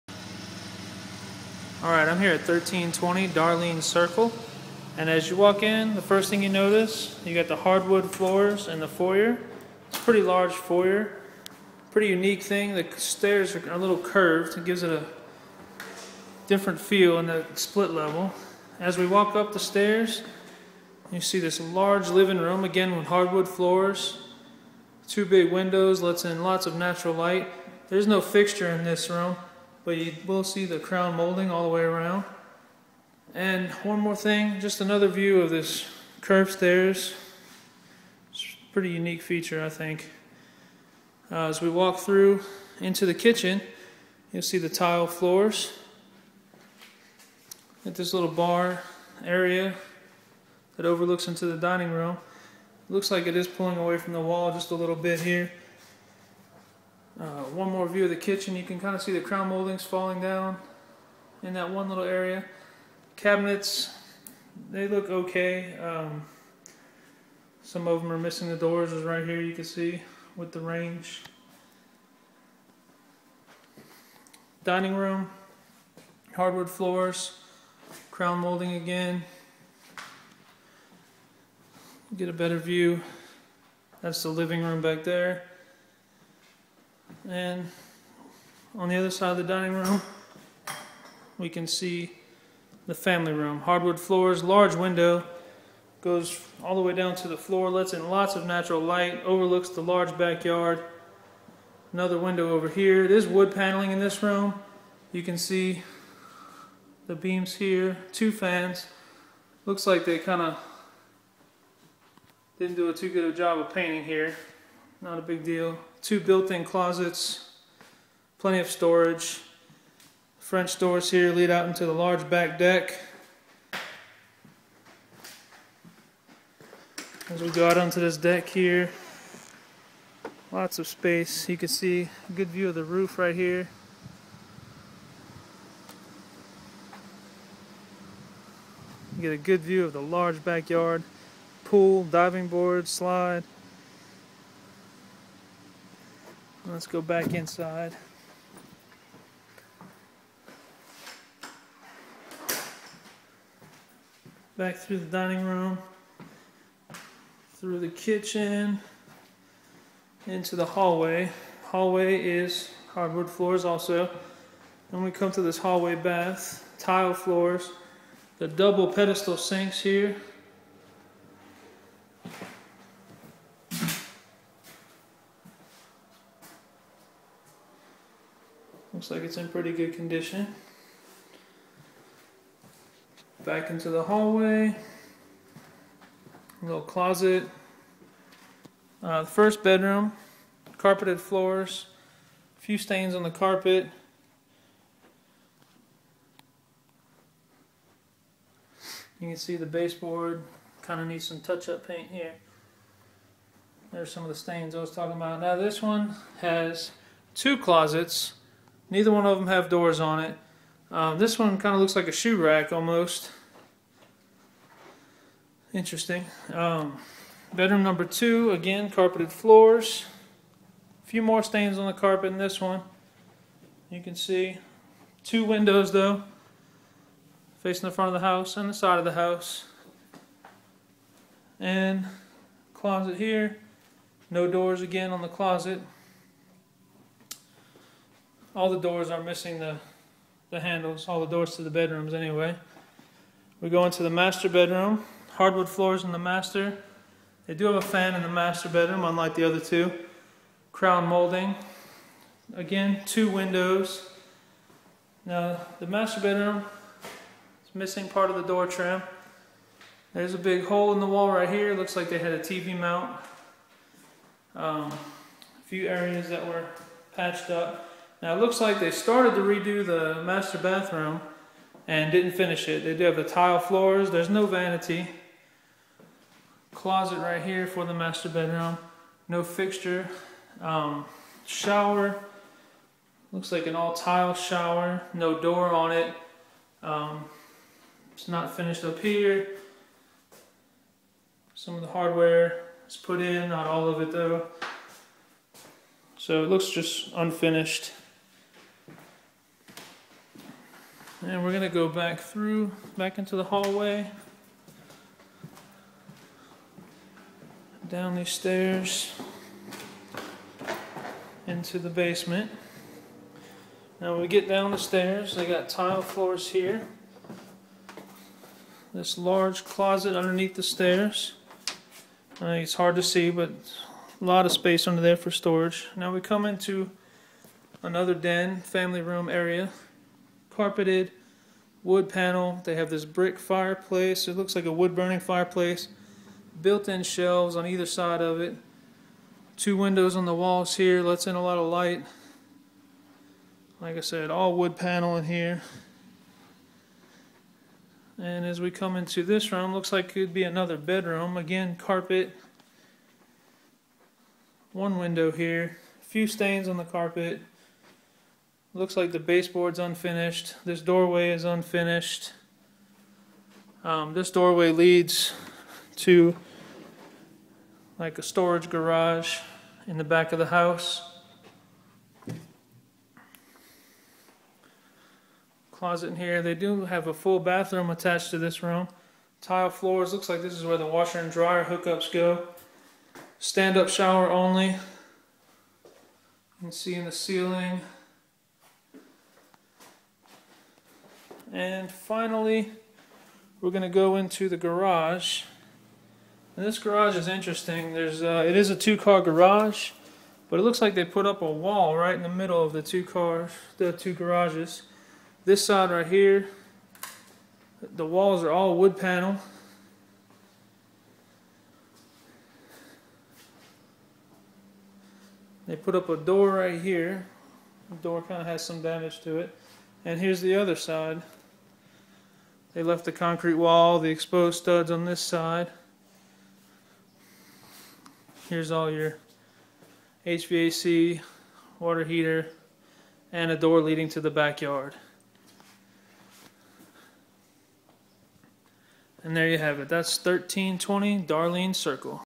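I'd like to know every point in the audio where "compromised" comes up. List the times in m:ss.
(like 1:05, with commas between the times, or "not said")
not said.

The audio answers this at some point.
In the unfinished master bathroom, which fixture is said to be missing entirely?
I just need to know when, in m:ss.
4:34.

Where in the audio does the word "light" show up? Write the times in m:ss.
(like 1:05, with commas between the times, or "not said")
0:27, 1:38, 5:41.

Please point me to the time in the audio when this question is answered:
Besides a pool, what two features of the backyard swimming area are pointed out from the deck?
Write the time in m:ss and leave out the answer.
2:22.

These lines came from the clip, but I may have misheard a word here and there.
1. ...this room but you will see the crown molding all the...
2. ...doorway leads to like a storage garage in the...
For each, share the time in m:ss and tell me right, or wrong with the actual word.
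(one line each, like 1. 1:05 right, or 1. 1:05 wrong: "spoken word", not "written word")
1. 0:28 right
2. 6:04 right.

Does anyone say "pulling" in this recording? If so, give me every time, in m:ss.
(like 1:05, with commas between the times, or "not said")
0:53.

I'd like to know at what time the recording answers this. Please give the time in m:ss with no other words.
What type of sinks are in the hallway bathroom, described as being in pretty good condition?
2:48.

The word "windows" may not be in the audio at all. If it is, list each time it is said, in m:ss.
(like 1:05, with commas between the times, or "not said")
0:25, 1:34, 1:42, 3:45, 4:13, 5:39, 5:54.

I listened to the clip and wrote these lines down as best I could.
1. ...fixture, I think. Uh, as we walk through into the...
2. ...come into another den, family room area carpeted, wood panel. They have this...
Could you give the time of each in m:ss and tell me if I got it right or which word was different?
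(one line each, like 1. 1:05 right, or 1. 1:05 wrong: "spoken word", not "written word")
1. 0:39 wrong: "feature", not "fixture"
2. 5:26 right.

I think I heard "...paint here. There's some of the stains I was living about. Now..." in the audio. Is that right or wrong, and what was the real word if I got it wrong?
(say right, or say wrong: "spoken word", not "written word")
wrong: "talking", not "living".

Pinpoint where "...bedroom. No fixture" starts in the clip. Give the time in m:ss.
4:38.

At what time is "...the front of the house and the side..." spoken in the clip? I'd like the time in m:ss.
3:47.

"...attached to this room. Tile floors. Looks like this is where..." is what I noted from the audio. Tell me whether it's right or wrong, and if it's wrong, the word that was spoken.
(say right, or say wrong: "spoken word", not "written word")
right.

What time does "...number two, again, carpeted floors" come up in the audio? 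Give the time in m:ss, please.
3:37.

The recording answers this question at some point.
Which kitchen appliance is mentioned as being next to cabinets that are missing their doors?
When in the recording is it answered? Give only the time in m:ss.
1:10.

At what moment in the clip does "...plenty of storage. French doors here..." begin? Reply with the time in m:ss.
1:58.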